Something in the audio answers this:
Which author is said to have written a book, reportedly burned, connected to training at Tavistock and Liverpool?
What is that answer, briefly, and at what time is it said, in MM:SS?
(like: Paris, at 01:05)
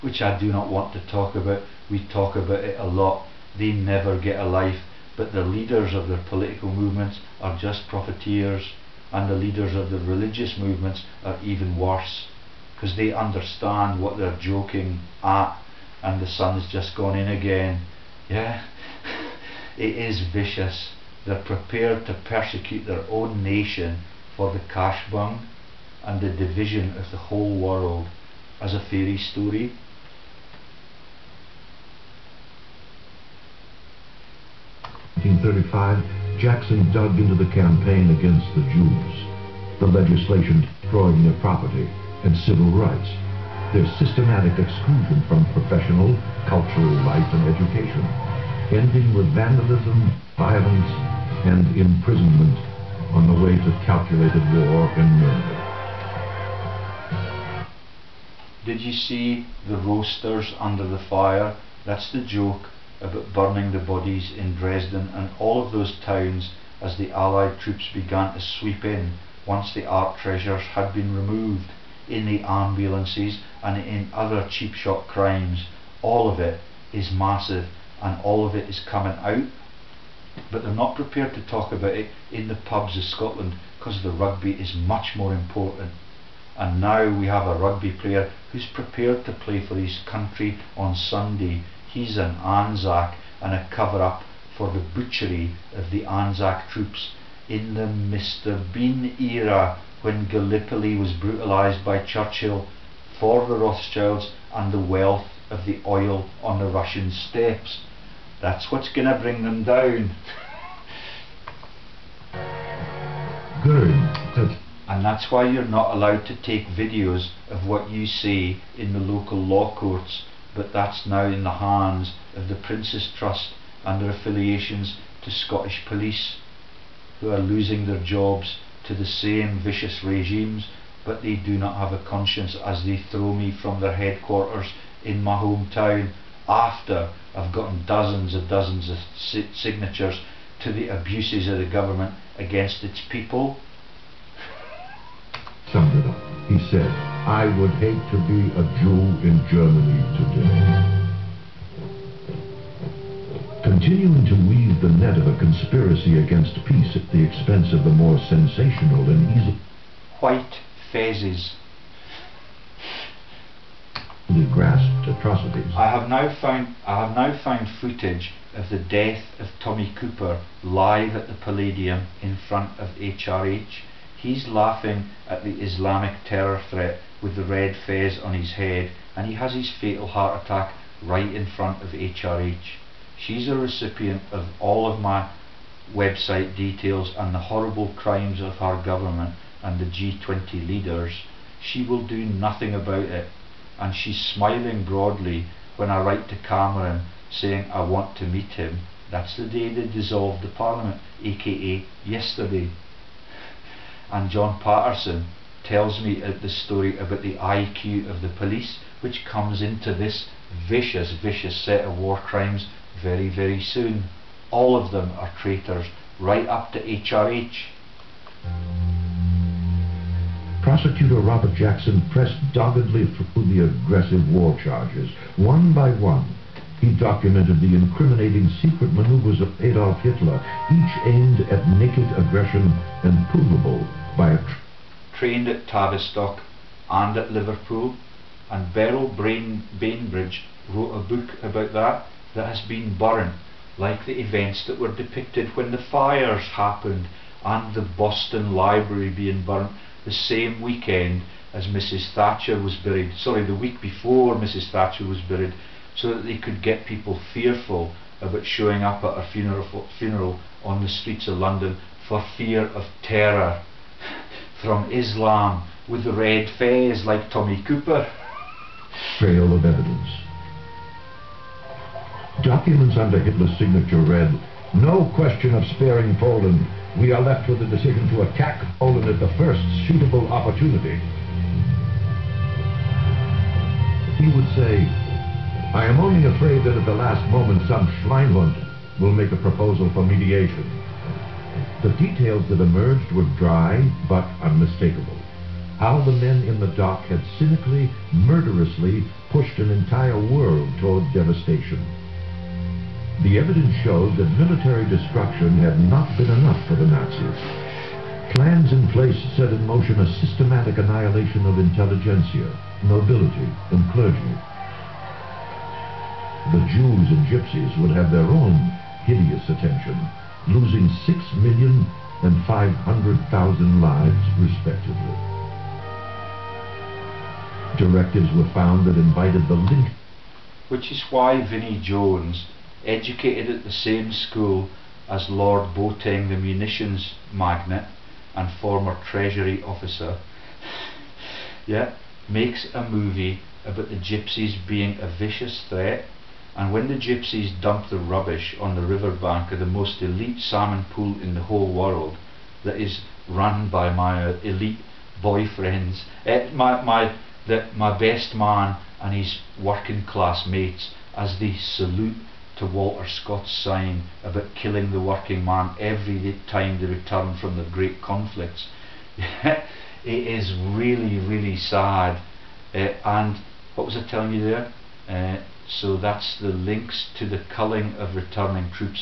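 Beryl Bainbridge, at 03:58.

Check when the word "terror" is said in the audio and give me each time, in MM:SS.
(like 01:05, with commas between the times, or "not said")
02:56, 04:23.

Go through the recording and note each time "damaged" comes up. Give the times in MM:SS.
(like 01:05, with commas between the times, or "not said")
not said.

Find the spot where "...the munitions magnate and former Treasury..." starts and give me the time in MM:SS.
05:36.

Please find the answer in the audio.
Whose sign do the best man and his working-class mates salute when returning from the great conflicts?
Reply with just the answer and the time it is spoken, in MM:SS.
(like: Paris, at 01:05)
Walter Scott, at 06:02.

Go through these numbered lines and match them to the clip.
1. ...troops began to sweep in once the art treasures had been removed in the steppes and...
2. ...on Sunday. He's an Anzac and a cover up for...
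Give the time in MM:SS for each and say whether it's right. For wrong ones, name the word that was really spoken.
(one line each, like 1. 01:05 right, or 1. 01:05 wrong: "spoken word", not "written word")
1. 01:07 wrong: "ambulances", not "steppes"
2. 01:30 right.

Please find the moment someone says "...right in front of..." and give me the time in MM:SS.
03:01.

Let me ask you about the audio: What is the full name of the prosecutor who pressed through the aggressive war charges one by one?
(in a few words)
Robert Jackson.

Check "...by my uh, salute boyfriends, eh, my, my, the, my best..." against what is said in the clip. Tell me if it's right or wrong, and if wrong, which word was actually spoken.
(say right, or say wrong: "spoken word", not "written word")
wrong: "elite", not "salute".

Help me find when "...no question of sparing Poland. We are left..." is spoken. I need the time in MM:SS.
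04:34.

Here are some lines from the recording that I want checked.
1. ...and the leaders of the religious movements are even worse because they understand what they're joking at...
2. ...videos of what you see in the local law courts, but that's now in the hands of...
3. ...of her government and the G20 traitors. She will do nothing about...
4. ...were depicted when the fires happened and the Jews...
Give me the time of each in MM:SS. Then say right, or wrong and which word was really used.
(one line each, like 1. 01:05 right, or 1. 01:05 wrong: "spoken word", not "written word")
1. 00:09 right
2. 01:56 right
3. 03:08 wrong: "leaders", not "traitors"
4. 04:04 wrong: "Boston", not "Jews".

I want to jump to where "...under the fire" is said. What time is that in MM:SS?
01:00.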